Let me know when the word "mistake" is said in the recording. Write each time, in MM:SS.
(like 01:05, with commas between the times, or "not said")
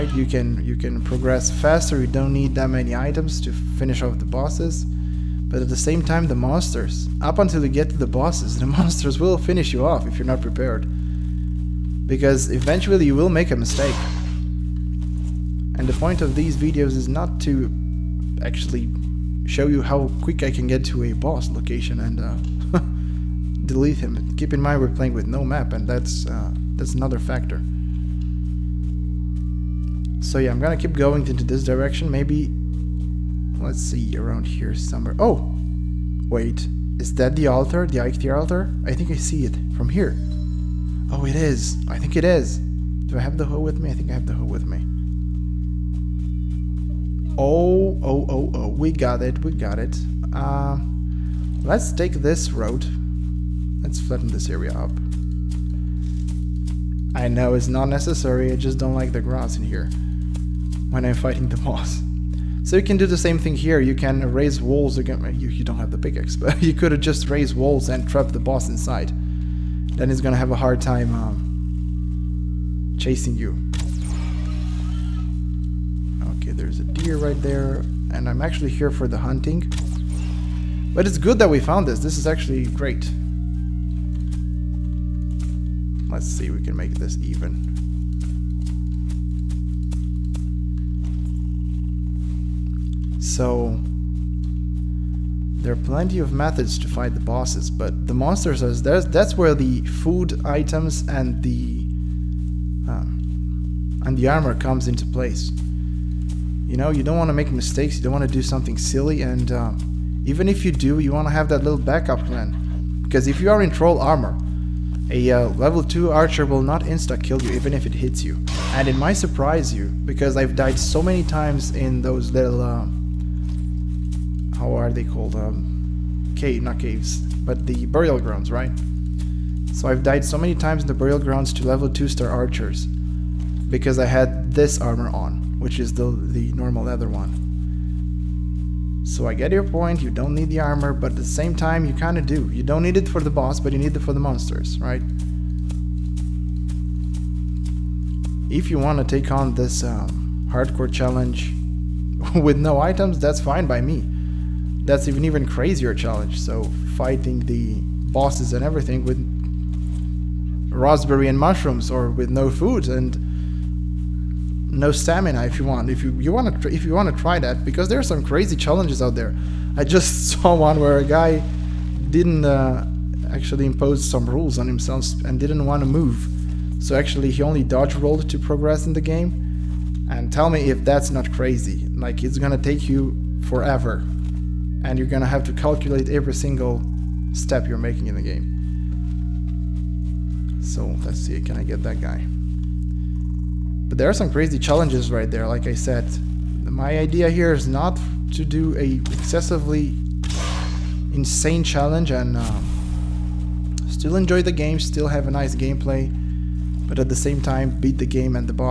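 00:13, 01:47.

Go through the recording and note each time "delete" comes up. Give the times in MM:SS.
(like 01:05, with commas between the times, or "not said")
00:23.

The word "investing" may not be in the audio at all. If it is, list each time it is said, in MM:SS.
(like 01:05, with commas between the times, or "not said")
not said.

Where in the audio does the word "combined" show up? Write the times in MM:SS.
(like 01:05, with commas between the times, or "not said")
not said.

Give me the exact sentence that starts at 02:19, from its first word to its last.
So I get your point, you don't need the armor, but at the same time you kind of do.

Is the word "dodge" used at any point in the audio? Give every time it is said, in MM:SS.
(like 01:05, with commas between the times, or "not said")
02:57.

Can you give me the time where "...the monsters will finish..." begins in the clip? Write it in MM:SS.
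00:08.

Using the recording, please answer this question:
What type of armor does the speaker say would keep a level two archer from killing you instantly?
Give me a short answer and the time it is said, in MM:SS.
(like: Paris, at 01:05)
troll armor, at 01:53.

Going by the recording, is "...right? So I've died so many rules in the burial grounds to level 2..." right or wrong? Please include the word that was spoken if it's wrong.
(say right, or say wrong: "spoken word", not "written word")
wrong: "times", not "rules".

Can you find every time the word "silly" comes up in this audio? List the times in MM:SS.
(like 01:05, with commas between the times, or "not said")
01:48.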